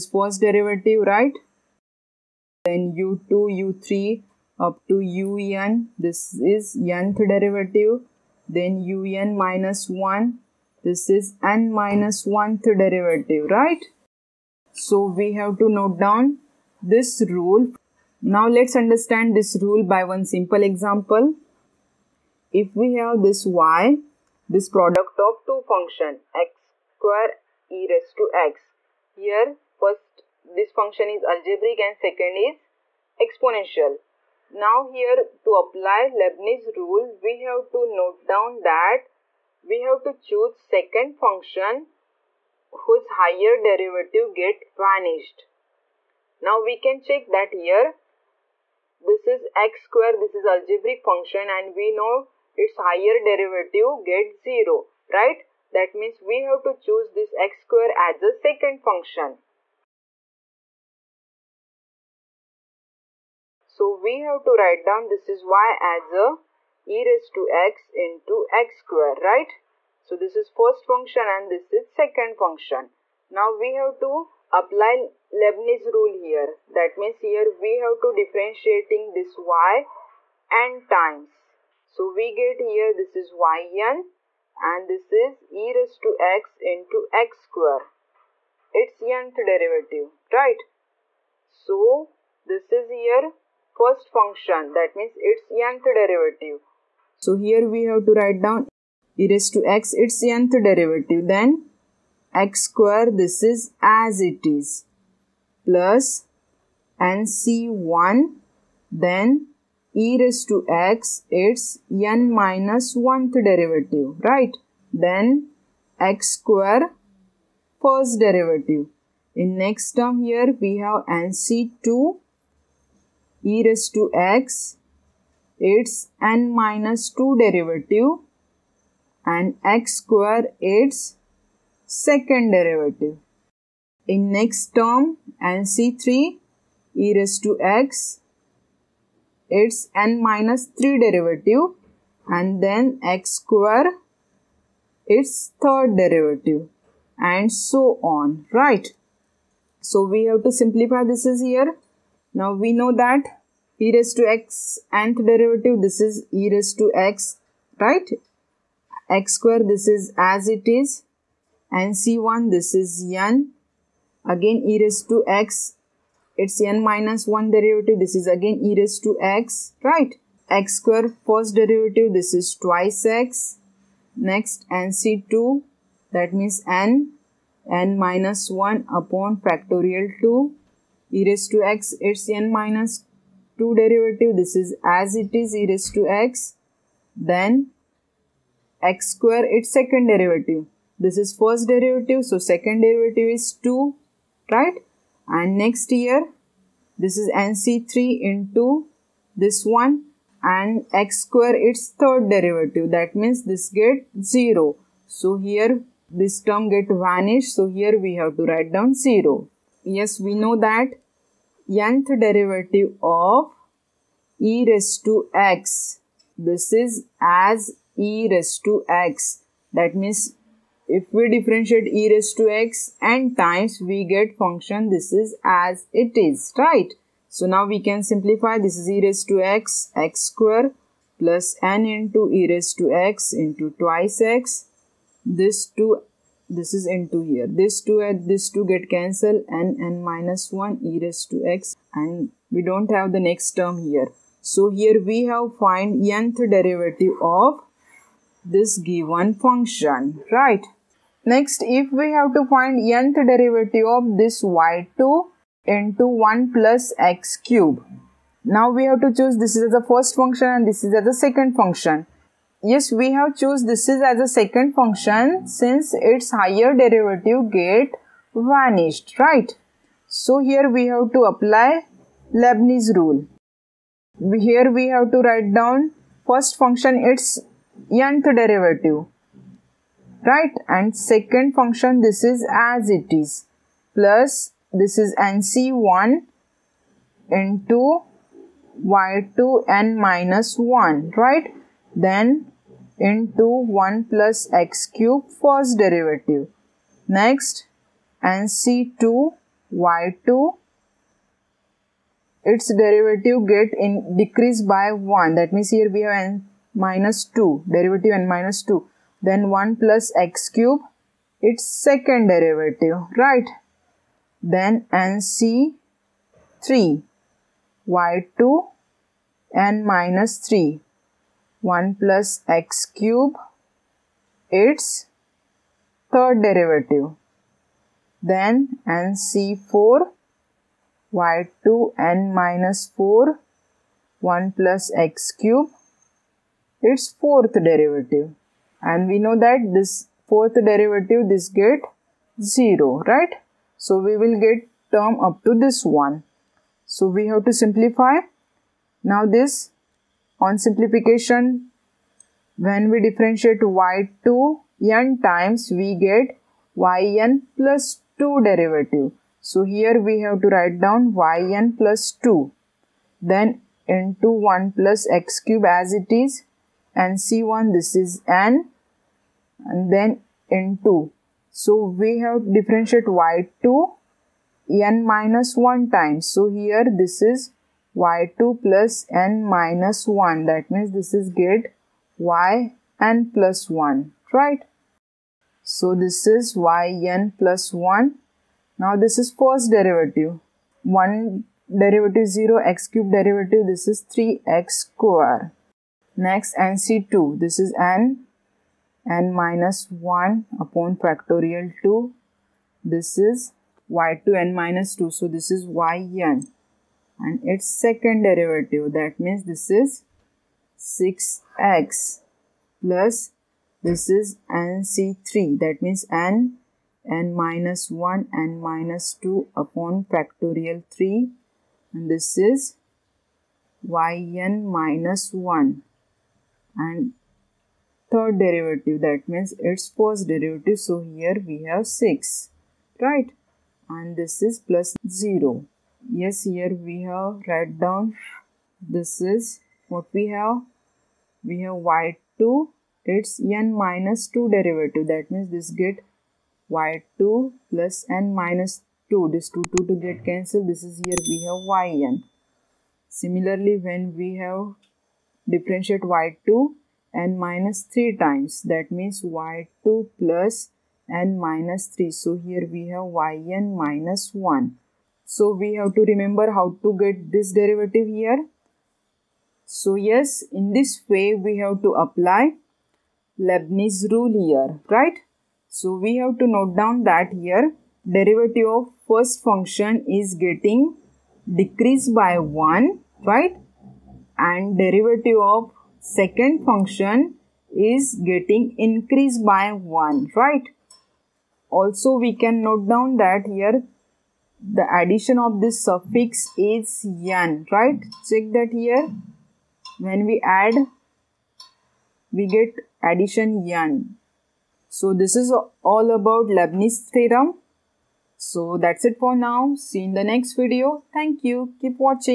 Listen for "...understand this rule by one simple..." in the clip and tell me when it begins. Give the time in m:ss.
0:18.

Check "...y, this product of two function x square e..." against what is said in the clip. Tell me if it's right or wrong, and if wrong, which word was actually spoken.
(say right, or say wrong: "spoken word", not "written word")
right.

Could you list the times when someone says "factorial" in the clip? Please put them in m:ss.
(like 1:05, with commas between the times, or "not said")
2:59, 6:40, 7:00.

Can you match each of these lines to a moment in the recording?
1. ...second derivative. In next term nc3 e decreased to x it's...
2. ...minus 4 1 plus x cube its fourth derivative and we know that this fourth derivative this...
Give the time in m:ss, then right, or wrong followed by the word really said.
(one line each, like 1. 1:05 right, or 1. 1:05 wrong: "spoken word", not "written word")
1. 2:12 wrong: "raised", not "decreased"
2. 5:32 right.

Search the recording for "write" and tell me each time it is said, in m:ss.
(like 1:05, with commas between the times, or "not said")
1:04, 1:38, 3:28, 4:35, 6:00, 7:17.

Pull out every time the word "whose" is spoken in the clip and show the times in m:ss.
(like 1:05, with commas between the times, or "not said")
0:42.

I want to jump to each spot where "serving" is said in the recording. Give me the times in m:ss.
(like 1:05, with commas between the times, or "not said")
not said.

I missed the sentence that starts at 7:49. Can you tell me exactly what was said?
So yes, in this way we have to apply Leibniz rule here, right?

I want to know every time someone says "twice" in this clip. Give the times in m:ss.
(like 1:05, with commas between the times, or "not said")
2:52, 3:53.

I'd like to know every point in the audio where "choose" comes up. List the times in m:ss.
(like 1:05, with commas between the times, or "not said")
0:40, 0:56, 4:19, 4:23.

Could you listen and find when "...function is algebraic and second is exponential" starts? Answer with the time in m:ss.
0:30.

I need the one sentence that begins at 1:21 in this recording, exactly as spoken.
So we get here this is yn and this is e raised to x into x square.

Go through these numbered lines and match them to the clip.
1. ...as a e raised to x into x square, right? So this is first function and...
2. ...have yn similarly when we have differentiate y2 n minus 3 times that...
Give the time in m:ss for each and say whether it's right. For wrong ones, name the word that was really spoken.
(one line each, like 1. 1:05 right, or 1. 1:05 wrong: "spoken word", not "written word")
1. 1:05 right
2. 7:31 right.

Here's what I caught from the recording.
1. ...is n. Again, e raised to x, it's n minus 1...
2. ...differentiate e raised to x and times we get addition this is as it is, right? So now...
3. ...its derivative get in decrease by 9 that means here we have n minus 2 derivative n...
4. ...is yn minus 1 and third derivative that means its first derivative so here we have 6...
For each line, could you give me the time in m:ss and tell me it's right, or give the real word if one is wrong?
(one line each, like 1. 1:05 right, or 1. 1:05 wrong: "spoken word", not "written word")
1. 2:42 right
2. 3:41 wrong: "function", not "addition"
3. 5:02 wrong: "1", not "9"
4. 7:02 right.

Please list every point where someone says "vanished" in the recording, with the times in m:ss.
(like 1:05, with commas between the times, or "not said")
0:44, 3:27, 4:28.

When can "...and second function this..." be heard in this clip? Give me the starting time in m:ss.
4:40.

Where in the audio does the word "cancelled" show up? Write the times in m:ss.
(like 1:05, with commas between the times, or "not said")
3:58, 7:30.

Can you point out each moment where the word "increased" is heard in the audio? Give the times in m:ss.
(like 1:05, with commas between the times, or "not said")
8:08.